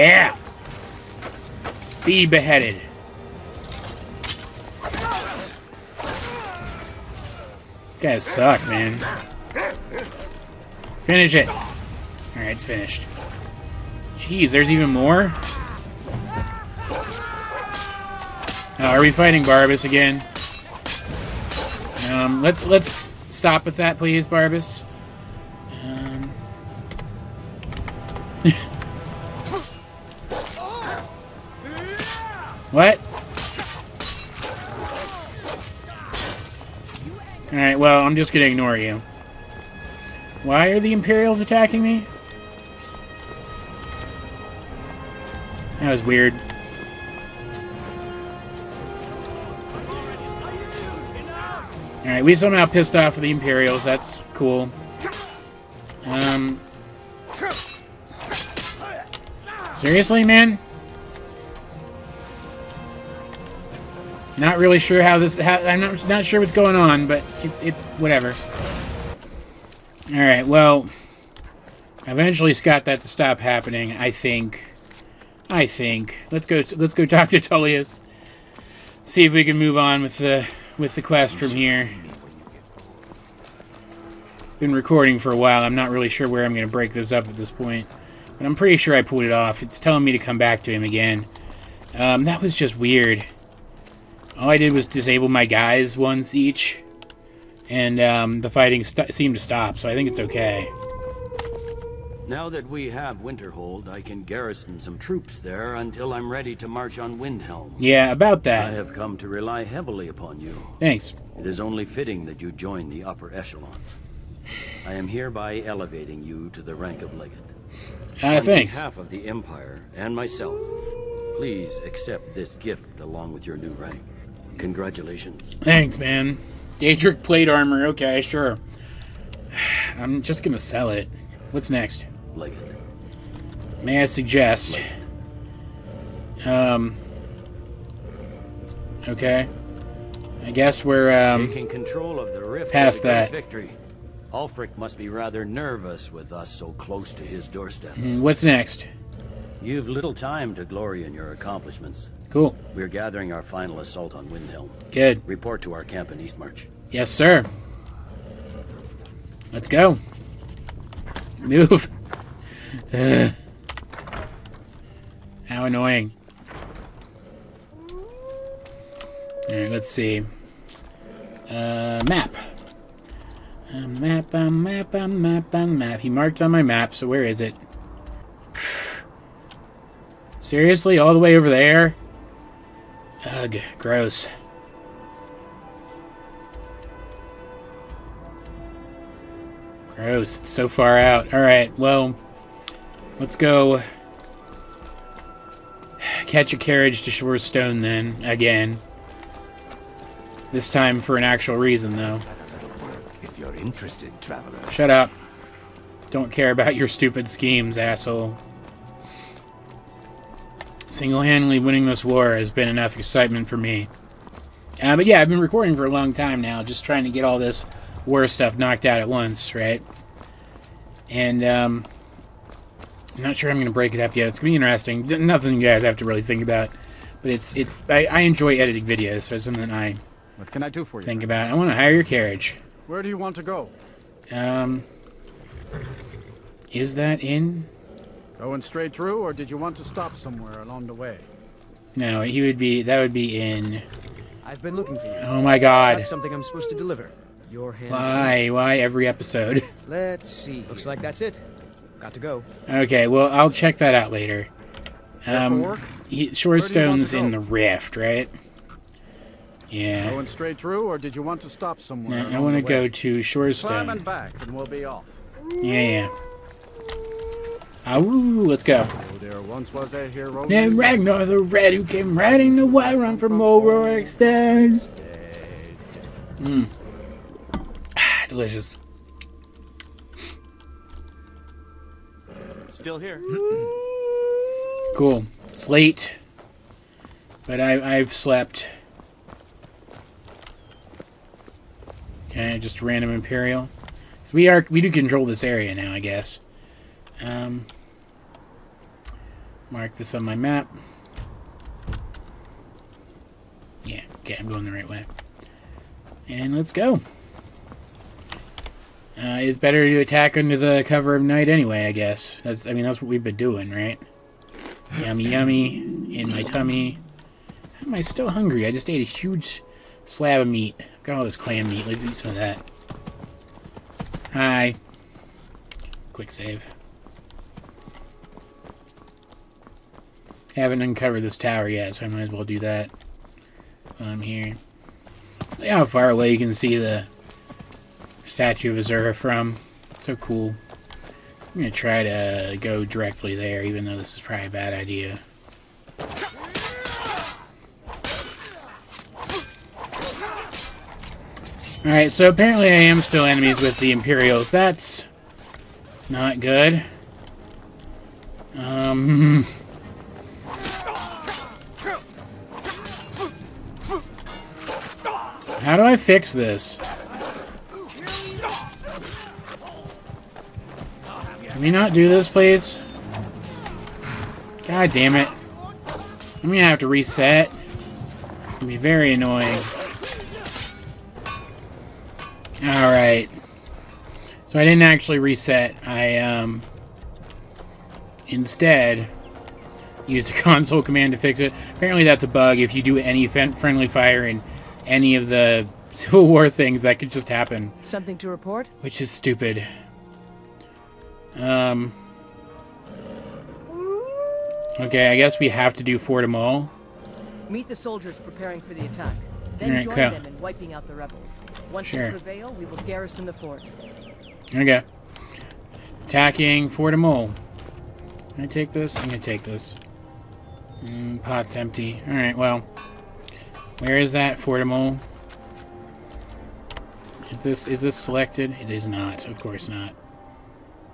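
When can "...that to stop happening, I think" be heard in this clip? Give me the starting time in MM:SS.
01:12.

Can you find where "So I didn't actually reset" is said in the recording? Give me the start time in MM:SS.
06:24.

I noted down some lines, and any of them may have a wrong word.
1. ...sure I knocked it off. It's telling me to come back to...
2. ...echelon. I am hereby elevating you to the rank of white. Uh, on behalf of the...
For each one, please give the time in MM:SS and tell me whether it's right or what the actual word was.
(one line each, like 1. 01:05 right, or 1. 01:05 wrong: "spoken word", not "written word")
1. 01:28 wrong: "pulled", not "knocked"
2. 01:53 wrong: "legate", not "white".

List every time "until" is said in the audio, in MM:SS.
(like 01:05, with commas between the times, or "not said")
01:45.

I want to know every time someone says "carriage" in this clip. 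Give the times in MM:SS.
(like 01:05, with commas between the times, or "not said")
03:16, 03:52.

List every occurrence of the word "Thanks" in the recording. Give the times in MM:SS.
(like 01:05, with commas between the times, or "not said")
01:50, 02:05.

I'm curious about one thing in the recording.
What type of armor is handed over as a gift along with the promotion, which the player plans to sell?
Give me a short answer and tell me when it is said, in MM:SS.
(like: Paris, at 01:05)
Daedric plate armor, at 02:06.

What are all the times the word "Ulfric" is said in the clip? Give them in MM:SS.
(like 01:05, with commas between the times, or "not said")
02:24.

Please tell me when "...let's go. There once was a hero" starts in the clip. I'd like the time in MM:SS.
04:27.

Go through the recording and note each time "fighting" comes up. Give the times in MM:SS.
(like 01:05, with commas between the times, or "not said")
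00:19, 01:38.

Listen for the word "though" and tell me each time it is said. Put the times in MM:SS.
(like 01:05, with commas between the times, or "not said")
03:21, 05:43.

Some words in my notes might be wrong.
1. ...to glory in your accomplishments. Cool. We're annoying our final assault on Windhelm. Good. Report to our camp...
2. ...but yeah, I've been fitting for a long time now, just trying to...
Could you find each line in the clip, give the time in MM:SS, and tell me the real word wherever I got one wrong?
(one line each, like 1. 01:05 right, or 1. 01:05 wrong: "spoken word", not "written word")
1. 02:30 wrong: "gathering", not "annoying"
2. 03:34 wrong: "recording", not "fitting".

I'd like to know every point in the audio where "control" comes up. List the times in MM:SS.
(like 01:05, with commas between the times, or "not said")
02:21, 04:54.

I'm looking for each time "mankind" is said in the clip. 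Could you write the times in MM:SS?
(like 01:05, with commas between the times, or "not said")
not said.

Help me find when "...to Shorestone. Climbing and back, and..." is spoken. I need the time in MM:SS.
04:22.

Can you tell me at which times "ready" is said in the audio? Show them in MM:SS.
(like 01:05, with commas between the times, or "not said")
01:46.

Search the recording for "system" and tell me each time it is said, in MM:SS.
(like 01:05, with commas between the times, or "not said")
not said.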